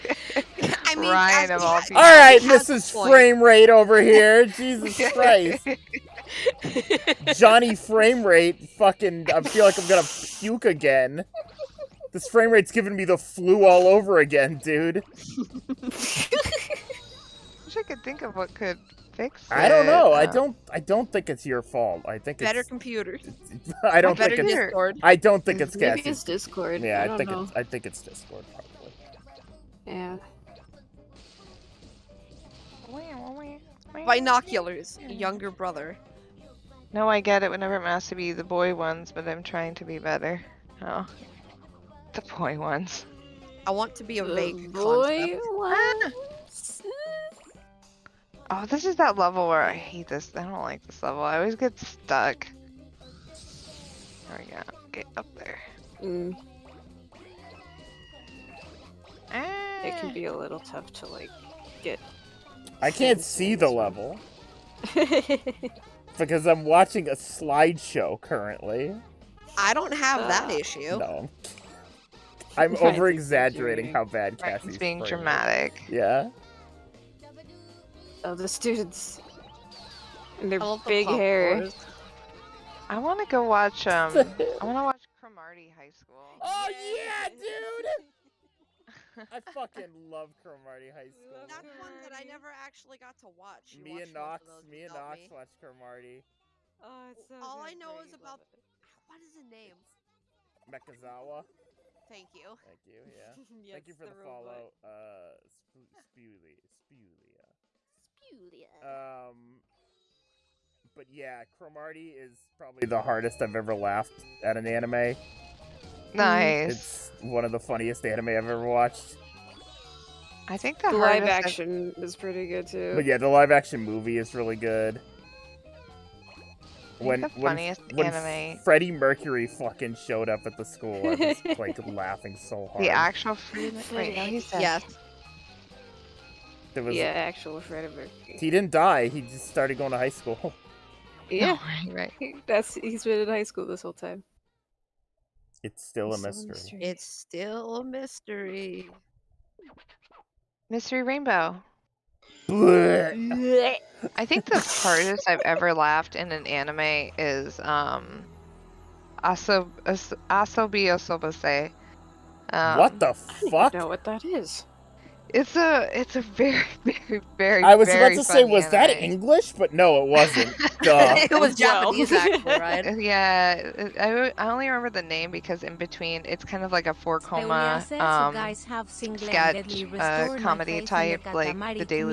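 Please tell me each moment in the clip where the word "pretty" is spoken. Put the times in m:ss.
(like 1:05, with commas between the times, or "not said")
2:02.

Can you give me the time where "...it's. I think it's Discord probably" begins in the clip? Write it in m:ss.
0:27.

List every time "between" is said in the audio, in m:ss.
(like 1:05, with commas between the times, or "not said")
2:55.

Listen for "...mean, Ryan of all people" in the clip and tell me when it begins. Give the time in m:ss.
0:00.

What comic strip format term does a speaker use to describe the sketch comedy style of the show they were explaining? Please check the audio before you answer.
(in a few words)
four koma.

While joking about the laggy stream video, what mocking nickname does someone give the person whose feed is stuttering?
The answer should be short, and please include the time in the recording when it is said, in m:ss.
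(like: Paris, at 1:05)
Johnny Frame Rate, at 0:07.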